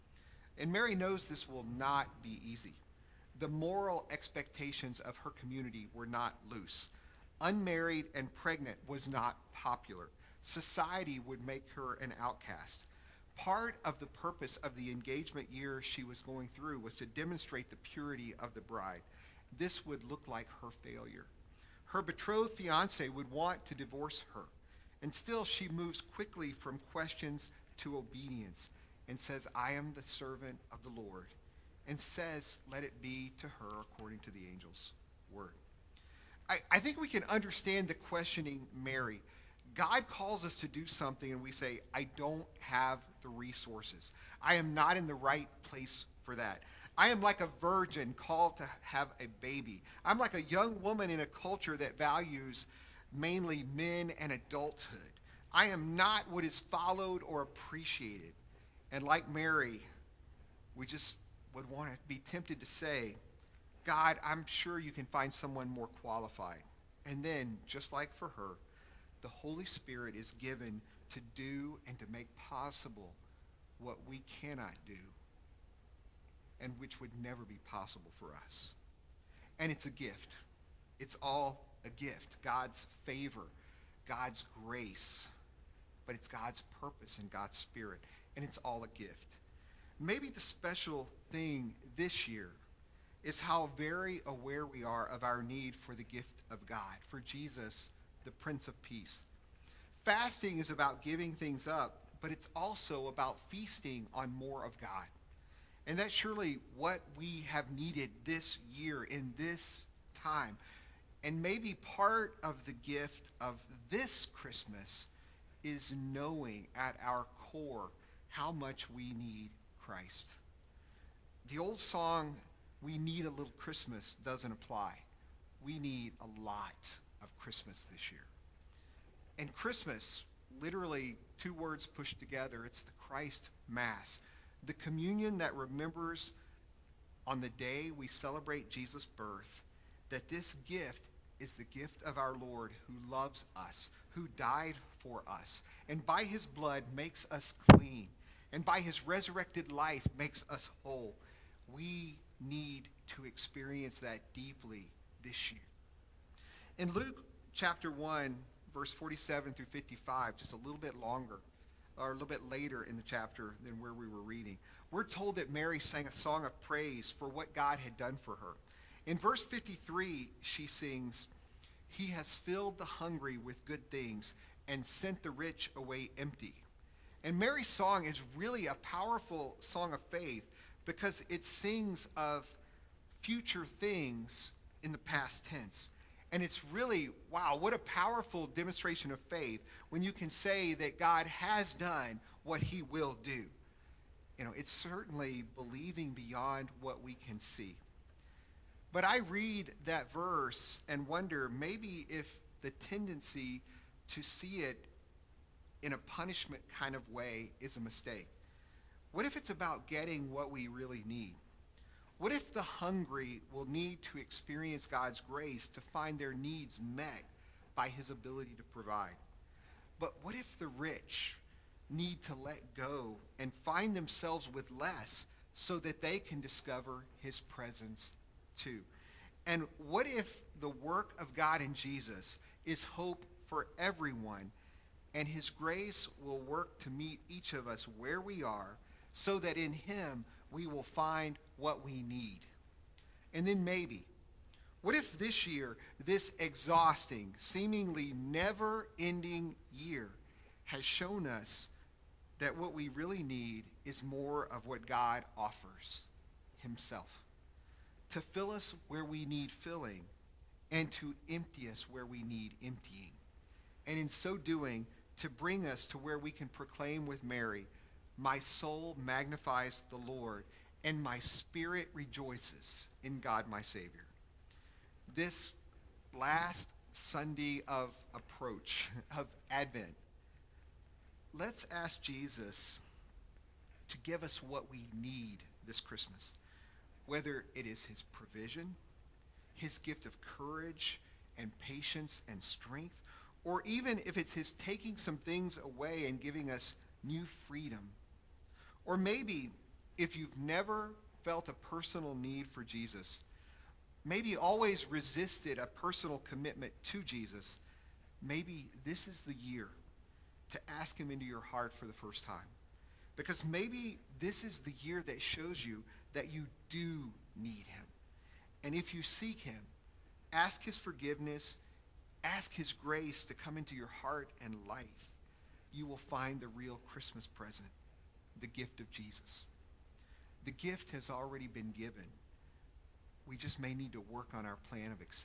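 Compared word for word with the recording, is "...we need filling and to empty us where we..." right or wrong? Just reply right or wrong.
right.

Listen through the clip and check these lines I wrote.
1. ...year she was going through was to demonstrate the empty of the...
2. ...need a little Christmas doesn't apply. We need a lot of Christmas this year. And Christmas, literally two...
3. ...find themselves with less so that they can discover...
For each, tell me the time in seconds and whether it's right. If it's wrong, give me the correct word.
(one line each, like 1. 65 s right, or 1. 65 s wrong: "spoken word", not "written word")
1. 15 s wrong: "purity", not "empty"
2. 122 s right
3. 223 s right.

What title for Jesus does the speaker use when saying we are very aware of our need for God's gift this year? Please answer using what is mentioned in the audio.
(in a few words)
Prince of Peace.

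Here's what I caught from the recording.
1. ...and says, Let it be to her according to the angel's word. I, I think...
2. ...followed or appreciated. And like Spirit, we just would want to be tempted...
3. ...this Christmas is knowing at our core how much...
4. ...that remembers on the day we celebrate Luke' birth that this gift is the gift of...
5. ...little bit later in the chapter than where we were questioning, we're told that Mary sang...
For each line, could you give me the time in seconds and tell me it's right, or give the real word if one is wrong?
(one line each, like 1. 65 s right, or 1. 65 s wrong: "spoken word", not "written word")
1. 31 s right
2. 56 s wrong: "Mary", not "Spirit"
3. 113 s right
4. 135 s wrong: "Jesus", not "Luke"
5. 162 s wrong: "reading", not "questioning".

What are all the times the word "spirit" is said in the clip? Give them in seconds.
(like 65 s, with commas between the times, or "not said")
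69 s, 87 s, 271 s.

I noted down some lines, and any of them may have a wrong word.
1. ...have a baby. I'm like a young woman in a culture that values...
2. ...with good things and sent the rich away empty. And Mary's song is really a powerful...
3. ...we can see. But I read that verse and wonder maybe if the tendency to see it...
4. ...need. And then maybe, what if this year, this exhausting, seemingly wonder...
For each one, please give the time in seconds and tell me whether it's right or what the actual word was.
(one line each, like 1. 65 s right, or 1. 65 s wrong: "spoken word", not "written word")
1. 48 s right
2. 173 s right
3. 197 s right
4. 242 s wrong: "never", not "wonder".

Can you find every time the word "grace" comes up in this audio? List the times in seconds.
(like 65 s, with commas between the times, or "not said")
84 s, 215 s, 235 s, 322 s.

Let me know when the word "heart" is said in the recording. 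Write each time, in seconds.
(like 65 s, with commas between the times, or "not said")
311 s, 323 s.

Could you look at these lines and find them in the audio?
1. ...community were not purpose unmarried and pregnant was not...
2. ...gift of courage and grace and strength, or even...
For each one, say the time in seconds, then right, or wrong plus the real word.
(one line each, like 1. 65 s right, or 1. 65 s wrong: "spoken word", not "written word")
1. 5 s wrong: "loose", not "purpose"
2. 289 s wrong: "patience", not "grace".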